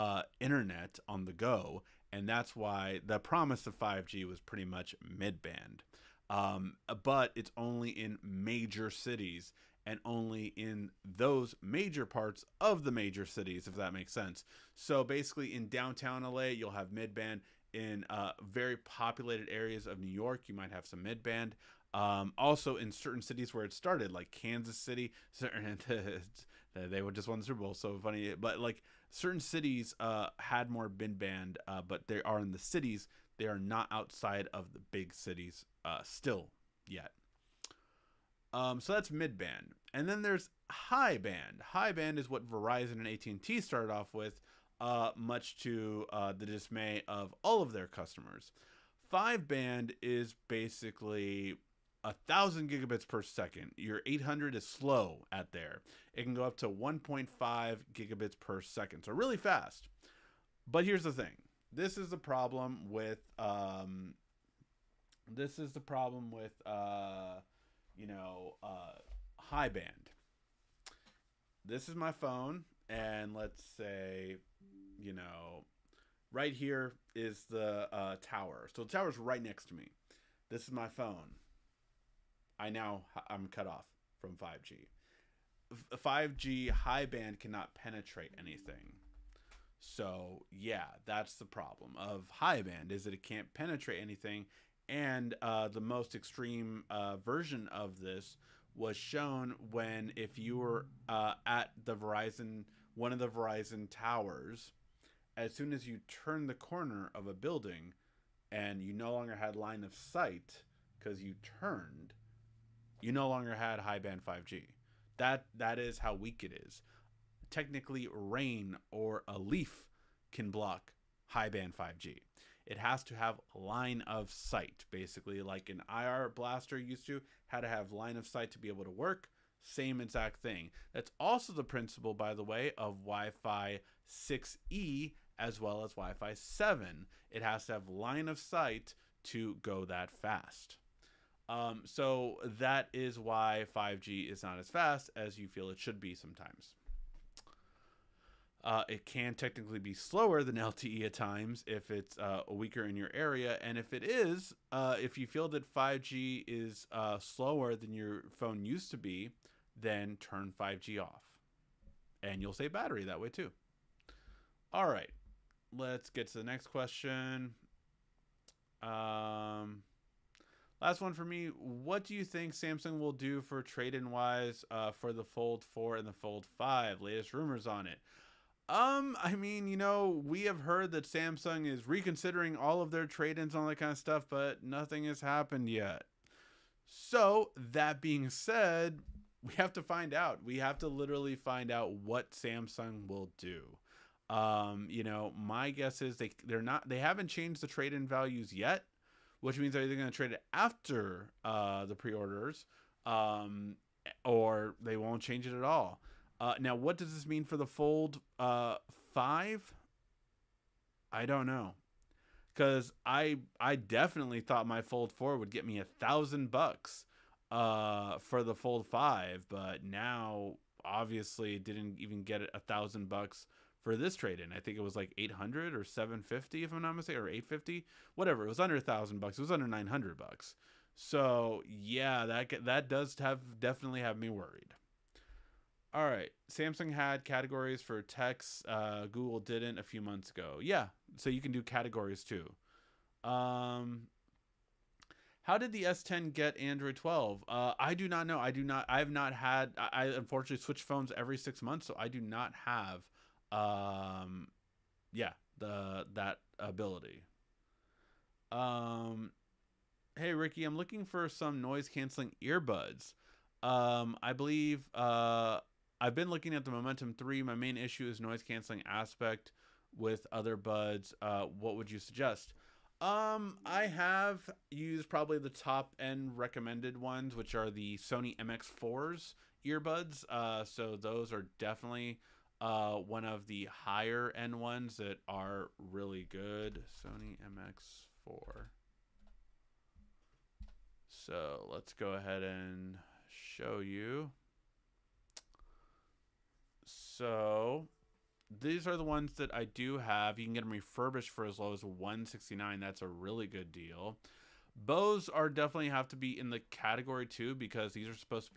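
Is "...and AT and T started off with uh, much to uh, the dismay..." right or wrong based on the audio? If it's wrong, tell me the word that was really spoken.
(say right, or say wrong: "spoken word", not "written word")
right.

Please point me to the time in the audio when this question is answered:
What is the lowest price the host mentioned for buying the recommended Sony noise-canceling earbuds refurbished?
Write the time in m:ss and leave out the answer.
5:01.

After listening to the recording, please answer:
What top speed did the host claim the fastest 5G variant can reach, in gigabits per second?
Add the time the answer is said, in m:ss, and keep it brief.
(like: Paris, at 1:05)
1.5, at 0:56.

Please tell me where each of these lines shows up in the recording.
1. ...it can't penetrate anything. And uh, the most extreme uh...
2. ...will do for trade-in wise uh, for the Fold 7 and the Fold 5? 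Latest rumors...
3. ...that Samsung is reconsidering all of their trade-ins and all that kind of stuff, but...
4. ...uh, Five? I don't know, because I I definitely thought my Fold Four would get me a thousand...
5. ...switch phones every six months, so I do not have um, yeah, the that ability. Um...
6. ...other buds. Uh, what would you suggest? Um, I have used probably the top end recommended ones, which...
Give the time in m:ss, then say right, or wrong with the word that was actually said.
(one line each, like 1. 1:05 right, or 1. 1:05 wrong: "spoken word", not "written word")
1. 1:33 right
2. 2:52 wrong: "4", not "7"
3. 3:00 right
4. 3:28 right
5. 4:10 right
6. 4:30 right.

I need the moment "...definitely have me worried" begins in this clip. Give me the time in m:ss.
3:53.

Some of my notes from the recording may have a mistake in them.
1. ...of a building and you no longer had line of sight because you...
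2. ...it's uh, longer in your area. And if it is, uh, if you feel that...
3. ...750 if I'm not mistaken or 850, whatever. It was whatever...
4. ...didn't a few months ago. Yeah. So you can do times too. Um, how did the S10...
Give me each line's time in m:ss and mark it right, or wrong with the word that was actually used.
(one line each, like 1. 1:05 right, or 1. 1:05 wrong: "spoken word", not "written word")
1. 1:47 right
2. 2:31 wrong: "weaker", not "longer"
3. 3:45 wrong: "under", not "whatever"
4. 3:59 wrong: "categories", not "times".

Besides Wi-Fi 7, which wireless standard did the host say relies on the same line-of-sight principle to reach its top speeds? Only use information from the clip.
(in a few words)
Wi-Fi 6E.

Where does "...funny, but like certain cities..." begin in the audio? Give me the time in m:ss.
0:28.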